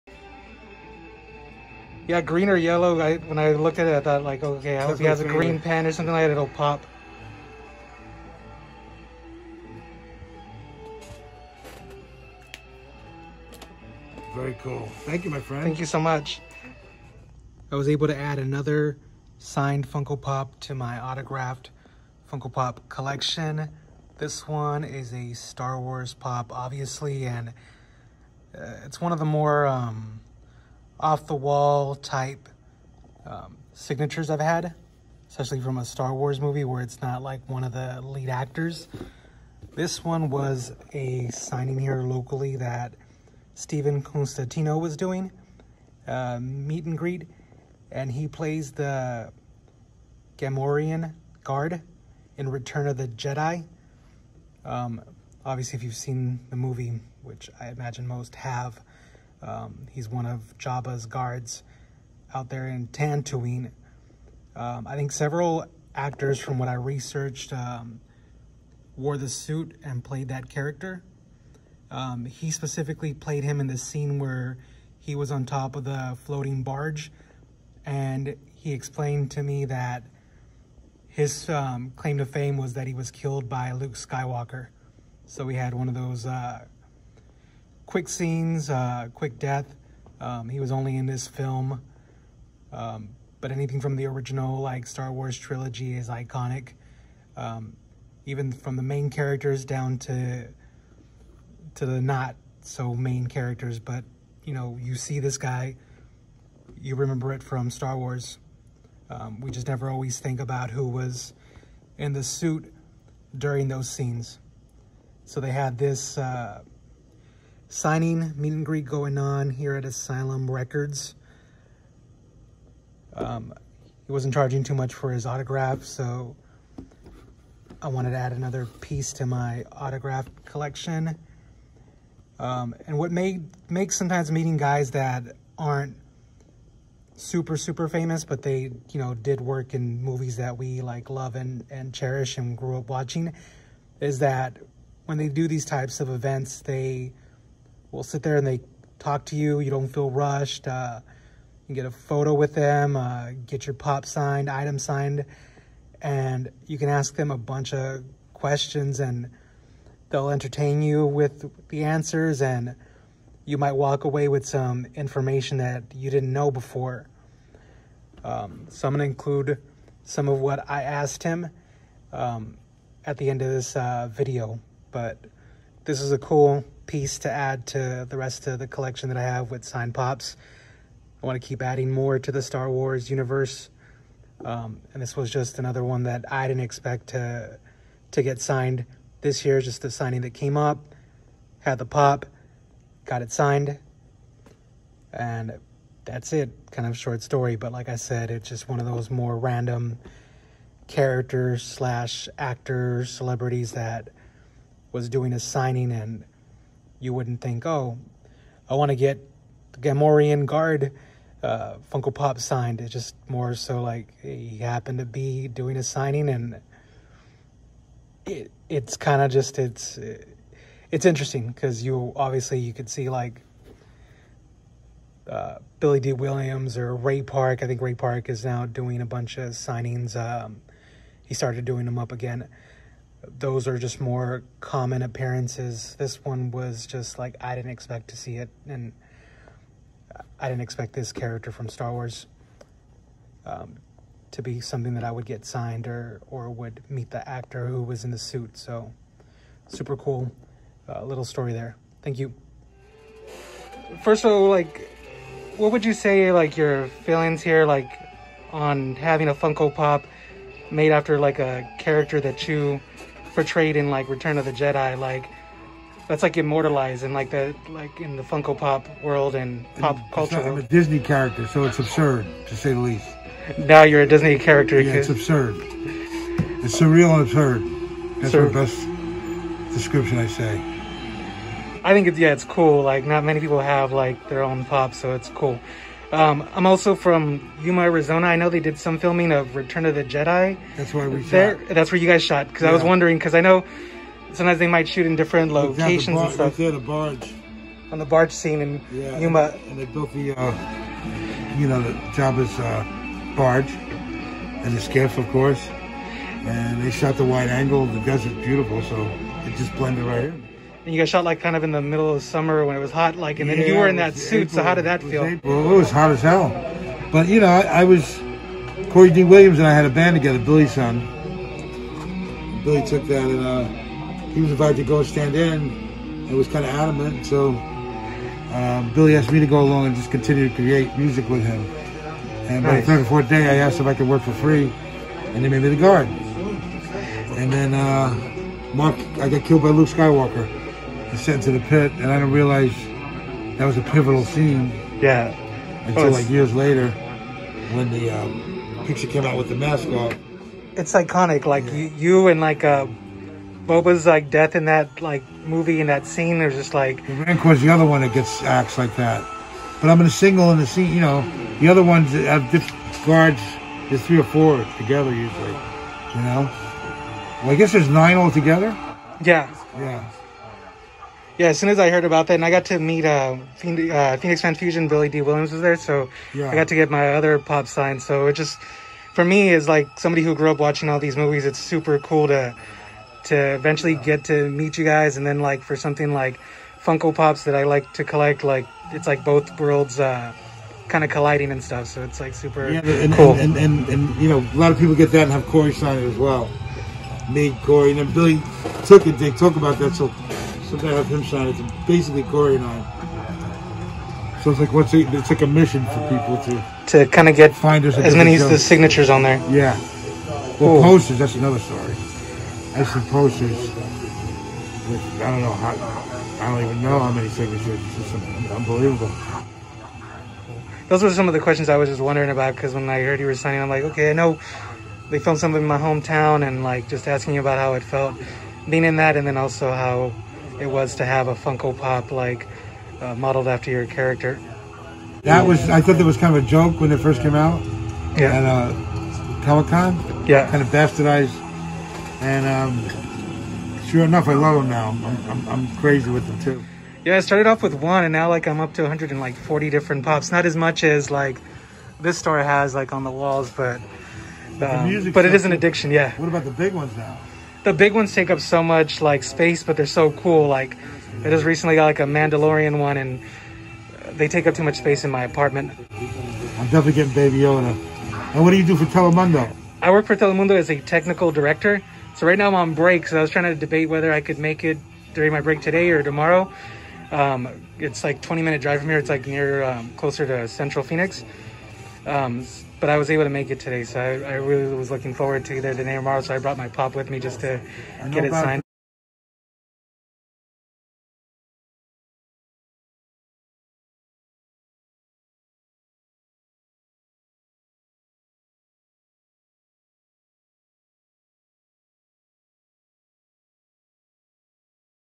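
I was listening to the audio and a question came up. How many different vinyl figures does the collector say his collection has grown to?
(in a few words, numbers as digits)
140.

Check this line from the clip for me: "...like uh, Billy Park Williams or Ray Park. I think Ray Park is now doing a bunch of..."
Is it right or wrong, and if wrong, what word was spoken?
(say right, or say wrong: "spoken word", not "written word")
wrong: "Dee", not "Park".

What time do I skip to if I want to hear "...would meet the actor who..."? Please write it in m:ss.
4:06.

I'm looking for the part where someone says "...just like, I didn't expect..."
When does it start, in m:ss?
3:56.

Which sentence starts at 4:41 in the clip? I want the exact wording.
I think it's yeah, it's cool.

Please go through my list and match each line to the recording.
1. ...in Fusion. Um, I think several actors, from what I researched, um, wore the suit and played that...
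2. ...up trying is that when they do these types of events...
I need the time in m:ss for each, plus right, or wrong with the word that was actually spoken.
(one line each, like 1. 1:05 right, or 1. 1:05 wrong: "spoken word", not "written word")
1. 1:02 wrong: "Tatooine", not "Fusion"
2. 2:22 wrong: "watching", not "trying".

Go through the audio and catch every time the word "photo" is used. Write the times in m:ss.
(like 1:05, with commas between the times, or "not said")
2:31.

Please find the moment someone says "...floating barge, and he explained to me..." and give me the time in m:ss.
1:16.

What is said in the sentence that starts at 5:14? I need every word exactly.
April, so how did that feel?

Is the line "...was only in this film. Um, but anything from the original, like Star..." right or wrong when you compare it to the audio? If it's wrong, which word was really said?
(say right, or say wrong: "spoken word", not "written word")
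right.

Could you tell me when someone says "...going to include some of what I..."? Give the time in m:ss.
2:48.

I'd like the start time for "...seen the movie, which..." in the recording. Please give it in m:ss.
0:55.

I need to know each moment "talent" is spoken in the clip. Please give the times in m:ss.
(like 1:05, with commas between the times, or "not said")
not said.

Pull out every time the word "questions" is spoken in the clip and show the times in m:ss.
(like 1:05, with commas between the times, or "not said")
2:38, 7:01.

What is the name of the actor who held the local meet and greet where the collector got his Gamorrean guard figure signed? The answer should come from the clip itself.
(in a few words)
Stephen Constantino.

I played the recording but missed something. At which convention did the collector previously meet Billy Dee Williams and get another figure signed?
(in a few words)
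Phoenix Fan Fusion.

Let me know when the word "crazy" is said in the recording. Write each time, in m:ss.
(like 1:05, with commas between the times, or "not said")
7:25.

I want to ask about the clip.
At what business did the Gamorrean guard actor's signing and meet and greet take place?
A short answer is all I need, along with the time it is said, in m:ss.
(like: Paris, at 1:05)
Asylum Records, at 1:59.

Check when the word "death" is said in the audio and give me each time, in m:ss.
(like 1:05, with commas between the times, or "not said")
1:29, 5:54.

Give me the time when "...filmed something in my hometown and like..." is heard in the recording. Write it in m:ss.
7:05.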